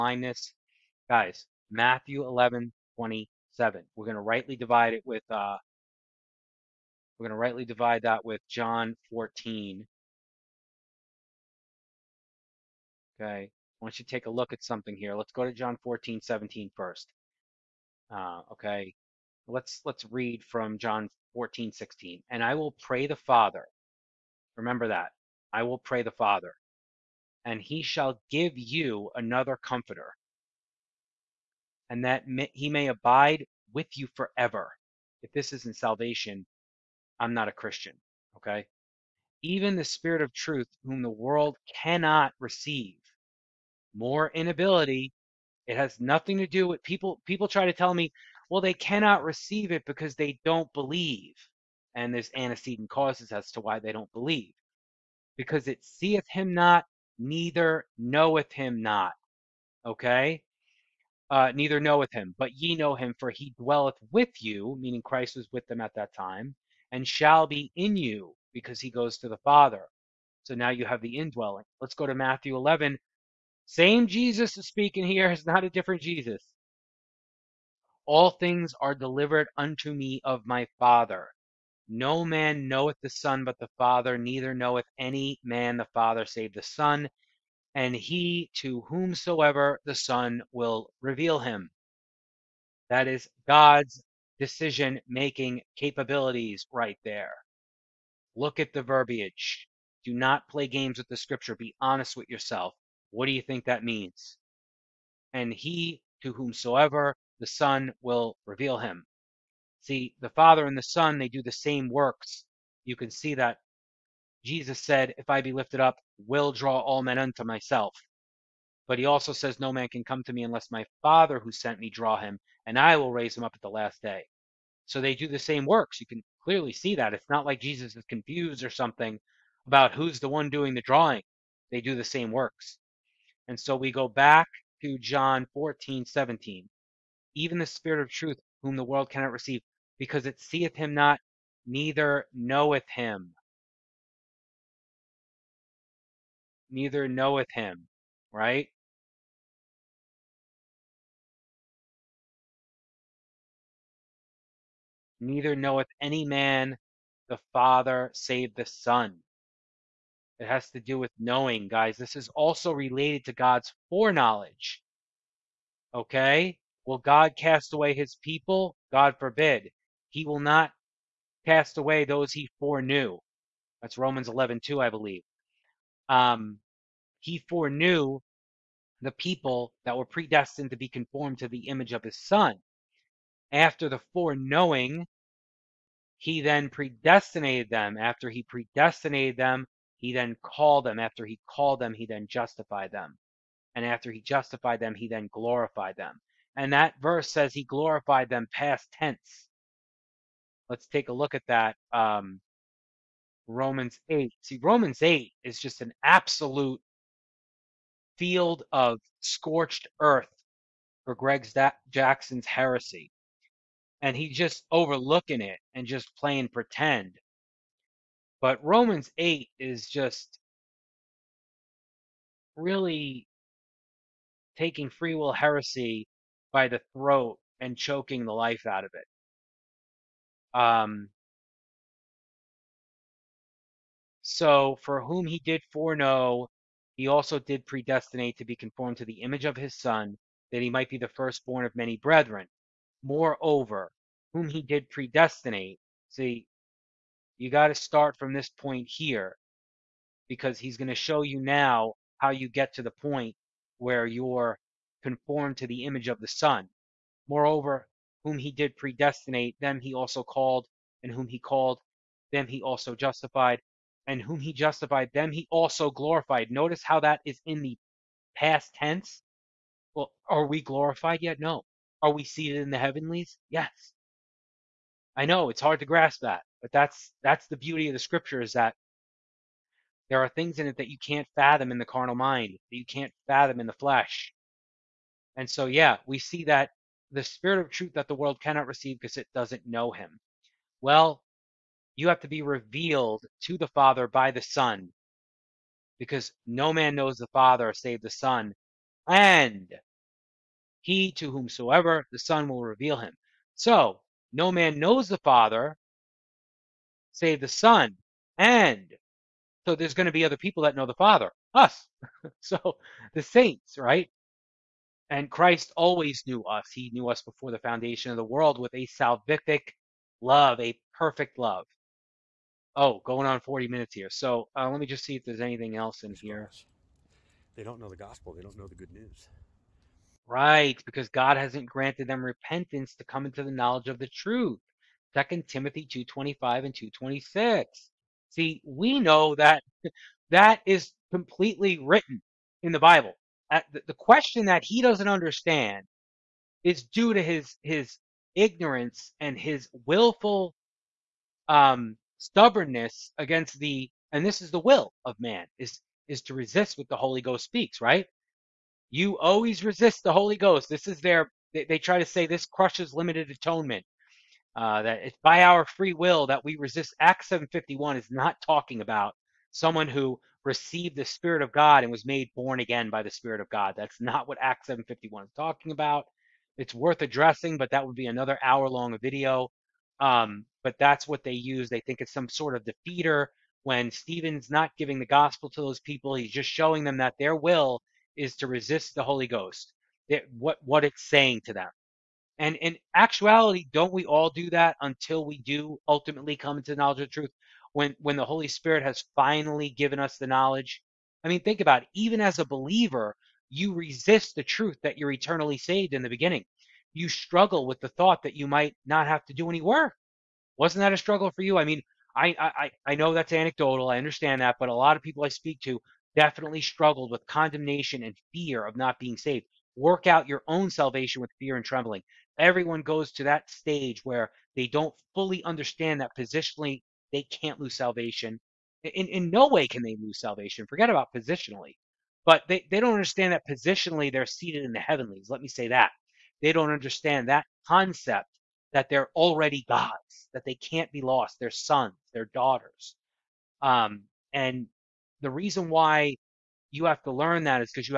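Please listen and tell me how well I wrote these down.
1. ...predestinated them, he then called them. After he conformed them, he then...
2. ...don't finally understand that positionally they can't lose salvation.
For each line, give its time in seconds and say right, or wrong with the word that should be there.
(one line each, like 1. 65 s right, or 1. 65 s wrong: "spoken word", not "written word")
1. 188 s wrong: "called", not "conformed"
2. 424 s wrong: "fully", not "finally".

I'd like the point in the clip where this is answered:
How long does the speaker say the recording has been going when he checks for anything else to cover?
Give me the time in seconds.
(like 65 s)
323 s.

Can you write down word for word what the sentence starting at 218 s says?
But Romans 8 is just really taking free will heresy by the throat and choking the life out of it.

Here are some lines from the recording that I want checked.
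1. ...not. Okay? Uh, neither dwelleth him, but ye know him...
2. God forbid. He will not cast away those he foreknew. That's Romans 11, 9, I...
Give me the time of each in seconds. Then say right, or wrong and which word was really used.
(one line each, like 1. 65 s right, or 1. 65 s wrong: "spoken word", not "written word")
1. 58 s wrong: "knoweth", not "dwelleth"
2. 168 s wrong: "2", not "9".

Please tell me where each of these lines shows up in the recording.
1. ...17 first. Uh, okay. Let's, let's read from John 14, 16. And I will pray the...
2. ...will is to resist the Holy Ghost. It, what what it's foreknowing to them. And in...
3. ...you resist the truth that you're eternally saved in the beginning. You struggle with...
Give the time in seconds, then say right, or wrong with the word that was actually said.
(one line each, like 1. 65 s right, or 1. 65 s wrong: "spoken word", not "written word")
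1. 16 s right
2. 387 s wrong: "saying", not "foreknowing"
3. 403 s right.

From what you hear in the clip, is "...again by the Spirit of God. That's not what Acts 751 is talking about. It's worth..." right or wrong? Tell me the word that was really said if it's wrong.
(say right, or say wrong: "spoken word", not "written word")
right.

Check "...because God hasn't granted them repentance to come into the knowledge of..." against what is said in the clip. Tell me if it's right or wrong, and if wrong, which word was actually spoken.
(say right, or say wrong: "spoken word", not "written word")
right.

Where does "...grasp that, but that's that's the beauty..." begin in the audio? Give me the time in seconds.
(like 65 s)
275 s.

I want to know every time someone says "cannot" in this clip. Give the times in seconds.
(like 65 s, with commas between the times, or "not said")
41 s, 48 s, 139 s, 288 s.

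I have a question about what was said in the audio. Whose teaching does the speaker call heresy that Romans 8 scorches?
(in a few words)
Gregg Jackson.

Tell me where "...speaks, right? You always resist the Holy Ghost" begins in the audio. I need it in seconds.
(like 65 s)
357 s.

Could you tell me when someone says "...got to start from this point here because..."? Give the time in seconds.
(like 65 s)
247 s.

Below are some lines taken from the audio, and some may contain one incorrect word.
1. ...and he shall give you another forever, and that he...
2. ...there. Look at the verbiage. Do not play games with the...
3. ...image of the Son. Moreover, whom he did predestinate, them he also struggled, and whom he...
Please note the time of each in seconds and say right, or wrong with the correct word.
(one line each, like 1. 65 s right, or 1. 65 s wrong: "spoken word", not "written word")
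1. 27 s wrong: "comforter", not "forever"
2. 97 s right
3. 255 s wrong: "called", not "struggled".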